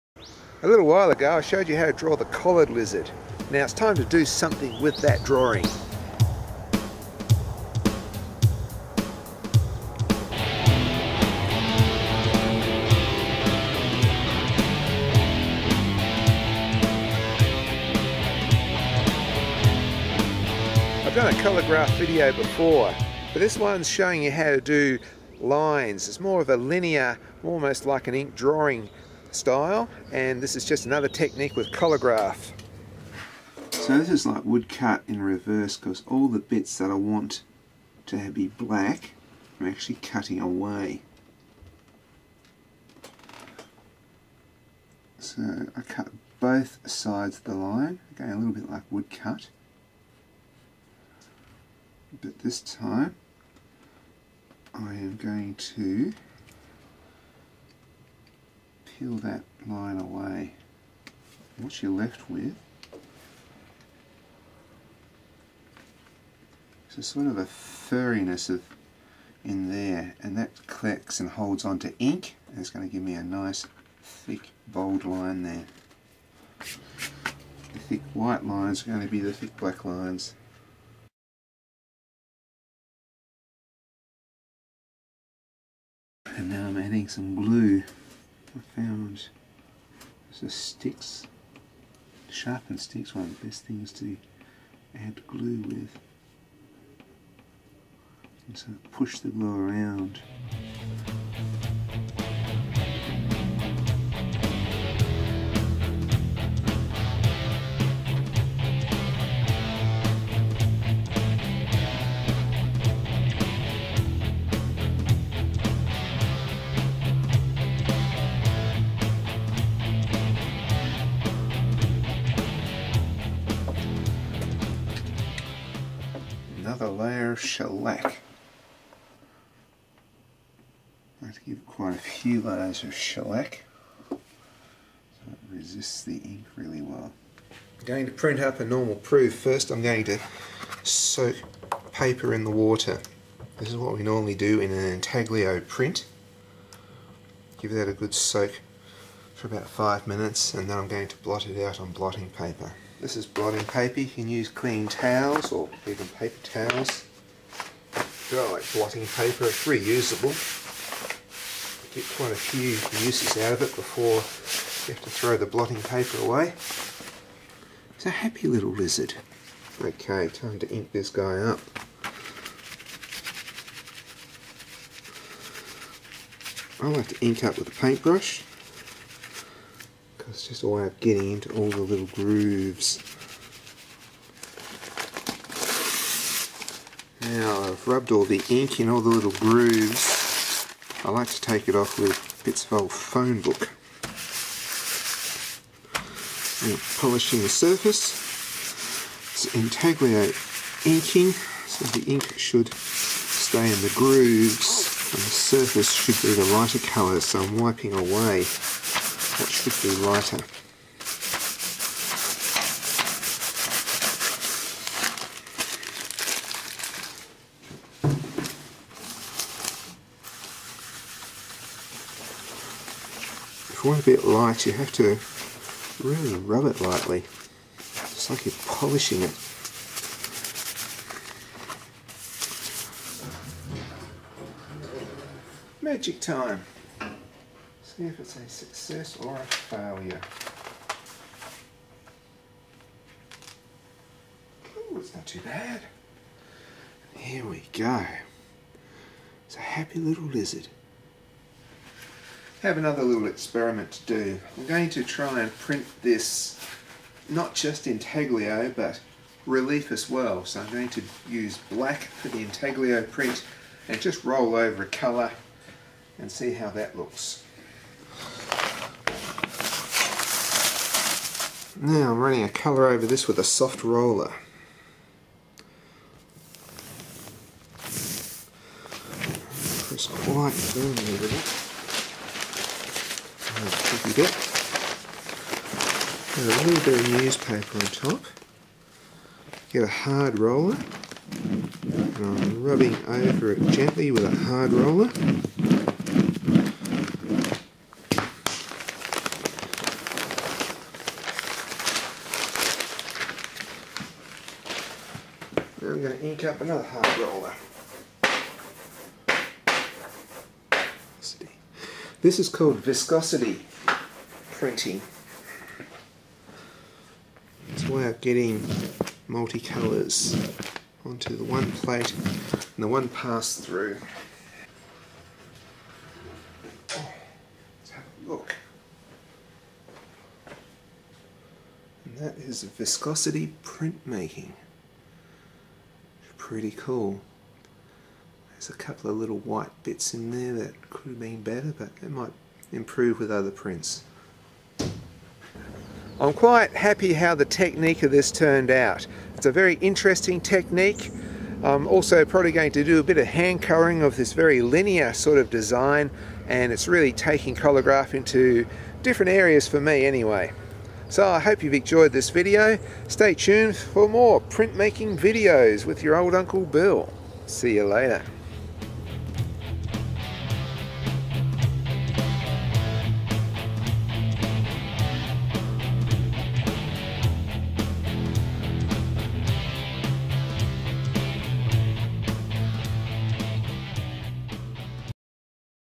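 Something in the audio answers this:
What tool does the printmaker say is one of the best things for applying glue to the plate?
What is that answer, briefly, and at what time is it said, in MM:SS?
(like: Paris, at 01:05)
sharpened sticks, at 01:32.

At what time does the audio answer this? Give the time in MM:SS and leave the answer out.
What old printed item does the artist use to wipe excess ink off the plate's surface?
03:12.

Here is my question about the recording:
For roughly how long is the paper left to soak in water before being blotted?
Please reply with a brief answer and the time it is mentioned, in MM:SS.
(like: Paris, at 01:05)
5 minutes, at 02:29.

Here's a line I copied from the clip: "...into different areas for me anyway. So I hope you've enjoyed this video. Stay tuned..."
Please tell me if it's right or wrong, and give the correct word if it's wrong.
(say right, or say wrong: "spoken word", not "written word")
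right.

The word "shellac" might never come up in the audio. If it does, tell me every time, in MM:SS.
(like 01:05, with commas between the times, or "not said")
02:07, 02:12.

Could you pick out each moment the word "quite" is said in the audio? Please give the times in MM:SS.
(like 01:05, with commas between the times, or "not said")
02:11, 02:42, 04:40, 05:46.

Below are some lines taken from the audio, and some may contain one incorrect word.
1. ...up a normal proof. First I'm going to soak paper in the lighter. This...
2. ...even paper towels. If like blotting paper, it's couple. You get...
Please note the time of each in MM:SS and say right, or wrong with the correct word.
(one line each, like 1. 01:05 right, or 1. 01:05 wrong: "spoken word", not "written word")
1. 02:18 wrong: "water", not "lighter"
2. 02:35 wrong: "reusable", not "couple".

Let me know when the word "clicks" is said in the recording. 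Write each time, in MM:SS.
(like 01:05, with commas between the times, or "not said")
01:10.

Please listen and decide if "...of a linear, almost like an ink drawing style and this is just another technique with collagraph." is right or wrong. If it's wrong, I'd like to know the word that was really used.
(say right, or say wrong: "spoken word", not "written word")
right.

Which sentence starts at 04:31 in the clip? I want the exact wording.
Now I'm running a colour over this with a soft roller.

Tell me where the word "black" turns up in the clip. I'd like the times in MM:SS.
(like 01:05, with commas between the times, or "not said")
00:38, 01:19, 04:21.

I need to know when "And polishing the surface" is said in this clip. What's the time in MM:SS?
03:16.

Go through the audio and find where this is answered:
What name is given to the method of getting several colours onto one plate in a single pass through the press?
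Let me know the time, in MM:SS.
05:12.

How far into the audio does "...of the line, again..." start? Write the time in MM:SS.
00:47.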